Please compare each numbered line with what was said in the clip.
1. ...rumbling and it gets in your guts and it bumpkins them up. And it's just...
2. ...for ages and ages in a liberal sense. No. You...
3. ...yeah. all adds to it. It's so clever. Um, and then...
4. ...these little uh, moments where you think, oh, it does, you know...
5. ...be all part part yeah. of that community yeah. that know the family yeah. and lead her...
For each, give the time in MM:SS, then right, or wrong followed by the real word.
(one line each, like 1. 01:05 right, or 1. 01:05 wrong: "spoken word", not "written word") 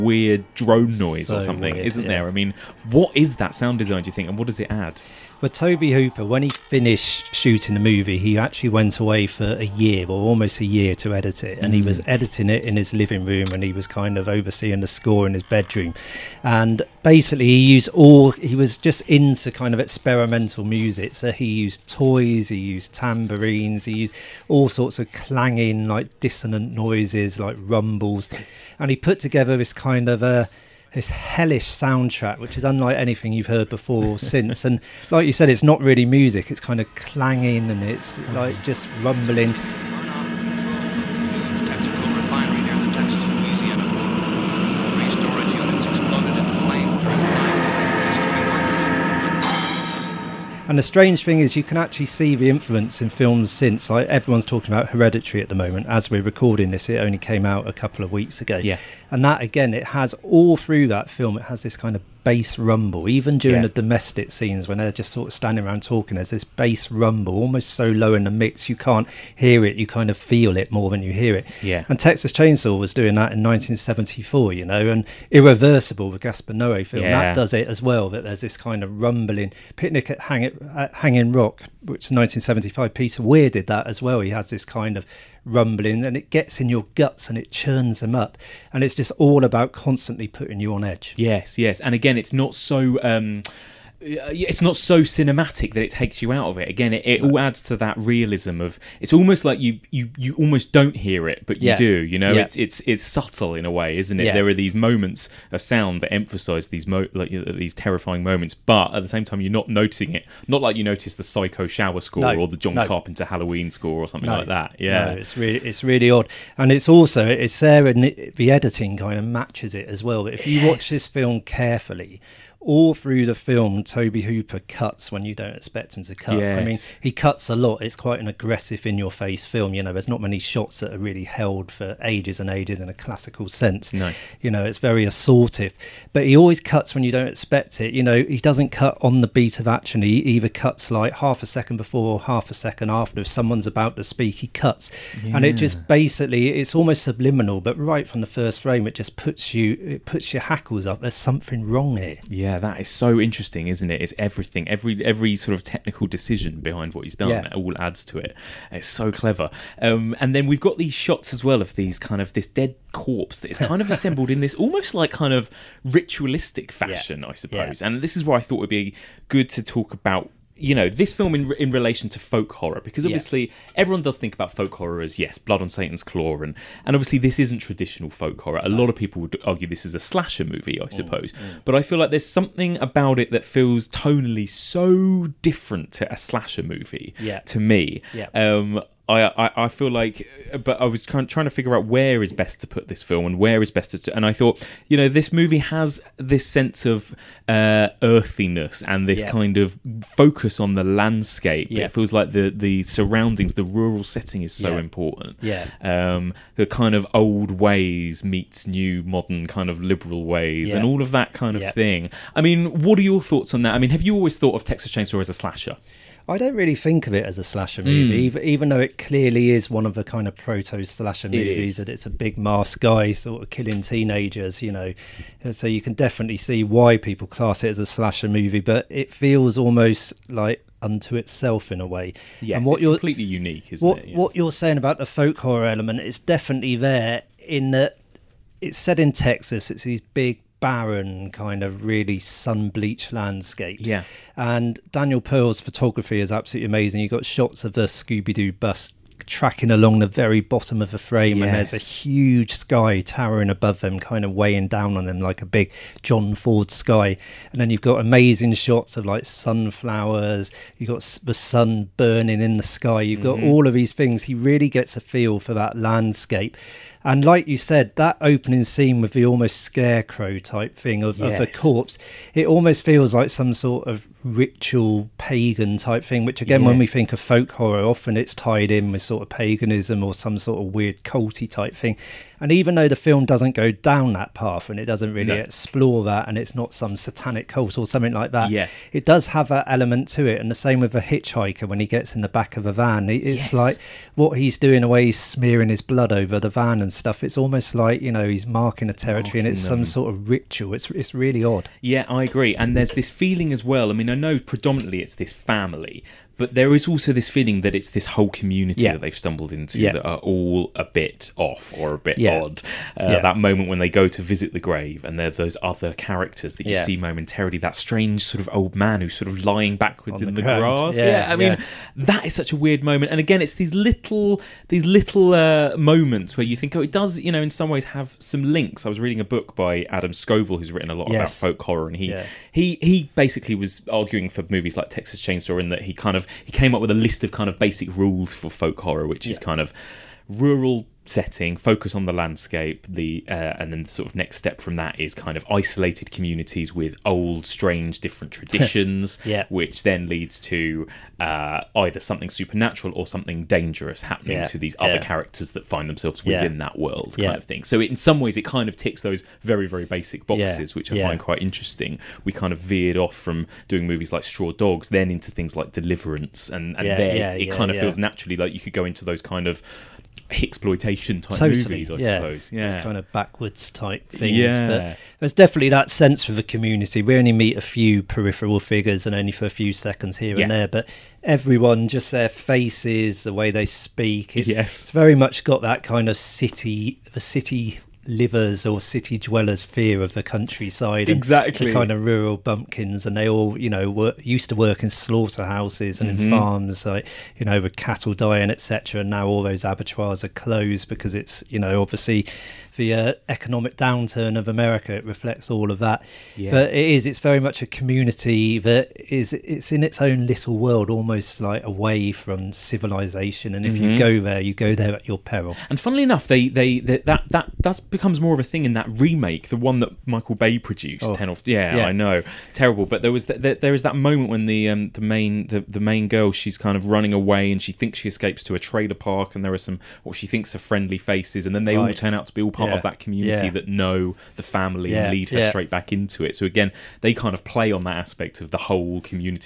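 1. 01:25 wrong: "churns", not "bumpkins"
2. 02:11 wrong: "classical", not "liberal"
3. 02:37 right
4. 05:24 right
5. 07:12 right.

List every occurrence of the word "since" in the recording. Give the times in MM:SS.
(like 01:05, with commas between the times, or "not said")
00:34, 00:53.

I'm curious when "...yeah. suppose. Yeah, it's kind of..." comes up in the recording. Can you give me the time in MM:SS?
06:11.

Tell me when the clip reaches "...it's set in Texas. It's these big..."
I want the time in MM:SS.
03:58.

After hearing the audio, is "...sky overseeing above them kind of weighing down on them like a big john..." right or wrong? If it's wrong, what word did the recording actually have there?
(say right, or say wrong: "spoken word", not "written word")
wrong: "towering", not "overseeing".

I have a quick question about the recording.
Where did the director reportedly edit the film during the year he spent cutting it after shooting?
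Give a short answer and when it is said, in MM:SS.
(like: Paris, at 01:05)
living room, at 00:12.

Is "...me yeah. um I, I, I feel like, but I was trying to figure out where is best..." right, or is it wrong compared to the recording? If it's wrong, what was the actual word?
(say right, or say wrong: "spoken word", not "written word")
right.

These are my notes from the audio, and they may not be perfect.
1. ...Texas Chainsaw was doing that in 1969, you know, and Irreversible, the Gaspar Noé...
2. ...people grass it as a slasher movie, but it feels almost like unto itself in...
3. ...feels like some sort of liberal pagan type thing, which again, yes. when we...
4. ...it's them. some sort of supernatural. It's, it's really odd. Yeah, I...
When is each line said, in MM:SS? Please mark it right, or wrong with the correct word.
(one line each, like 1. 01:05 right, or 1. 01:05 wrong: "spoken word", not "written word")
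1. 01:11 wrong: "1974", not "1969"
2. 03:46 wrong: "class", not "grass"
3. 04:32 wrong: "ritual", not "liberal"
4. 04:59 wrong: "ritual", not "supernatural".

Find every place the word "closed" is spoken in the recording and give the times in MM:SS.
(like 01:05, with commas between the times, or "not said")
06:40.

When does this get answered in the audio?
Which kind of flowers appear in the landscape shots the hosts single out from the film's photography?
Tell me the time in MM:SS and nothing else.
04:19.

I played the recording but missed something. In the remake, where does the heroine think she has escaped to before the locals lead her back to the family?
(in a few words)
a trailer park.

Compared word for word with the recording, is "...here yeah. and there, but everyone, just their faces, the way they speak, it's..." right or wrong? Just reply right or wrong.
right.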